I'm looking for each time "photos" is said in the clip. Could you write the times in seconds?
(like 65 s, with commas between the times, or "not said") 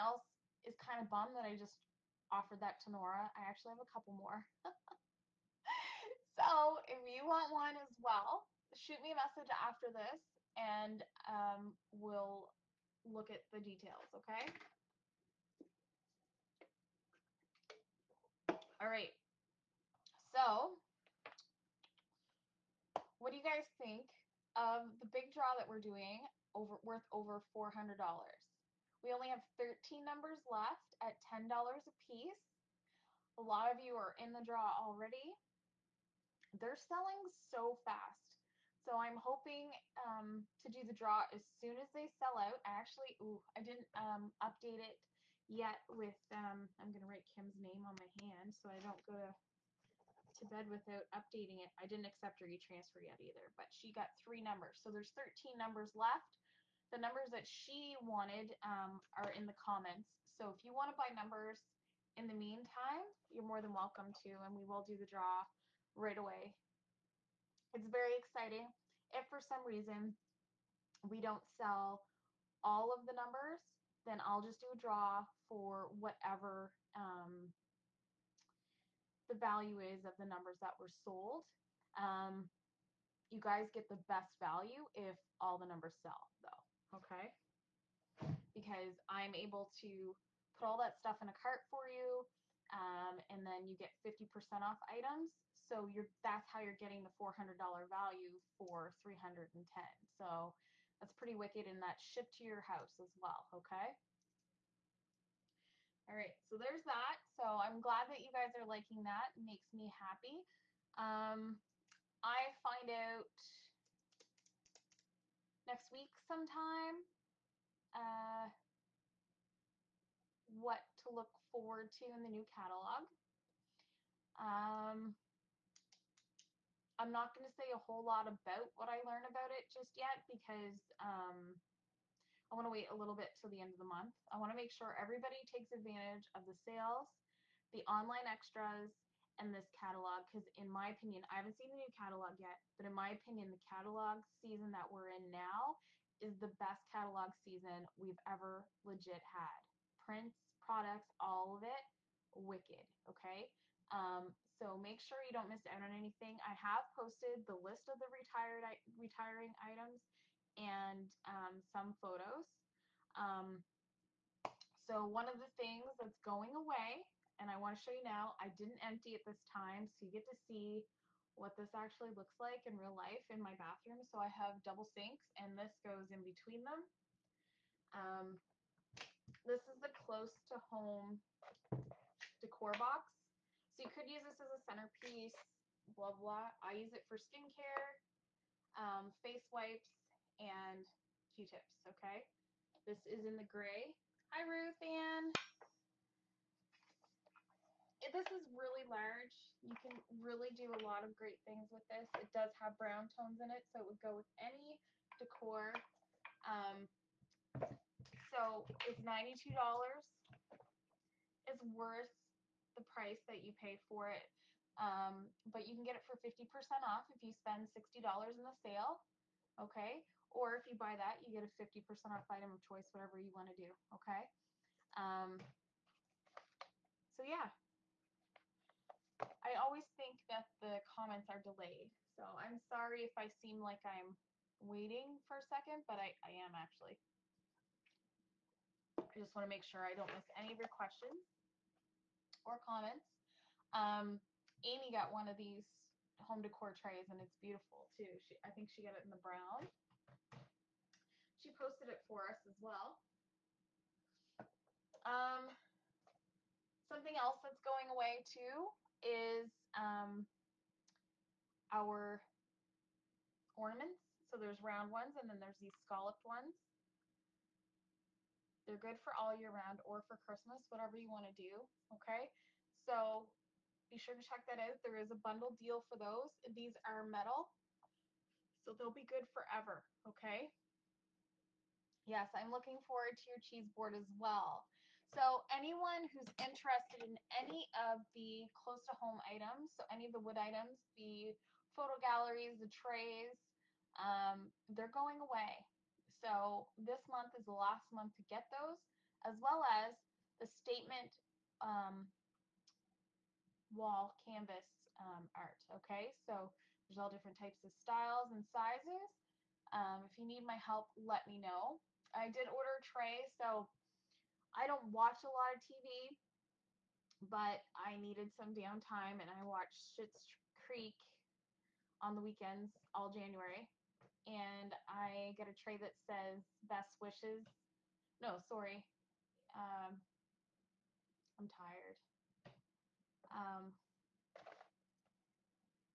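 162 s, 291 s.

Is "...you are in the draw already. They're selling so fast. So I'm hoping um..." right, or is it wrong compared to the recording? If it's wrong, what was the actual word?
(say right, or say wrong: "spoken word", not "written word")
right.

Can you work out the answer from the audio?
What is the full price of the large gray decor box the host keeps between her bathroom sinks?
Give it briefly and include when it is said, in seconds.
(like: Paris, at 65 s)
$92, at 209 s.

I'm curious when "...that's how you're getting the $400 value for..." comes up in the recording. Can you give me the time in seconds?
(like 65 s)
96 s.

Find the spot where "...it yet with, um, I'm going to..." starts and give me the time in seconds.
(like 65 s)
44 s.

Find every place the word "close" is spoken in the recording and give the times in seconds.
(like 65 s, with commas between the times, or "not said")
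179 s, 288 s.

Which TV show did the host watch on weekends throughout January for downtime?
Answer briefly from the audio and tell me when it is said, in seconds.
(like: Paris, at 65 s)
Schitt's Creek, at 319 s.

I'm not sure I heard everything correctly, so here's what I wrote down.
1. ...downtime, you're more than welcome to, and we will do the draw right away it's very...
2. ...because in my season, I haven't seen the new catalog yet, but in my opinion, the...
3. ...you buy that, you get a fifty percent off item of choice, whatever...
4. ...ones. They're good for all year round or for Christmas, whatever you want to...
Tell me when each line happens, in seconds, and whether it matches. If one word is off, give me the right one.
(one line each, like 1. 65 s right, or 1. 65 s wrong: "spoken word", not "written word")
1. 62 s wrong: "meantime", not "downtime"
2. 140 s wrong: "opinion", not "season"
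3. 220 s right
4. 266 s right.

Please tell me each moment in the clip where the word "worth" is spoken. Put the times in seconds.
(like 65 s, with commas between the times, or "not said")
26 s, 211 s.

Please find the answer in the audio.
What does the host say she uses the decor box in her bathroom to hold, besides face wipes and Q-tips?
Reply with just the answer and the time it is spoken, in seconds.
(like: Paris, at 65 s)
Skincare, at 187 s.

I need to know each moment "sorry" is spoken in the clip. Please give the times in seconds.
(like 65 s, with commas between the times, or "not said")
232 s, 328 s.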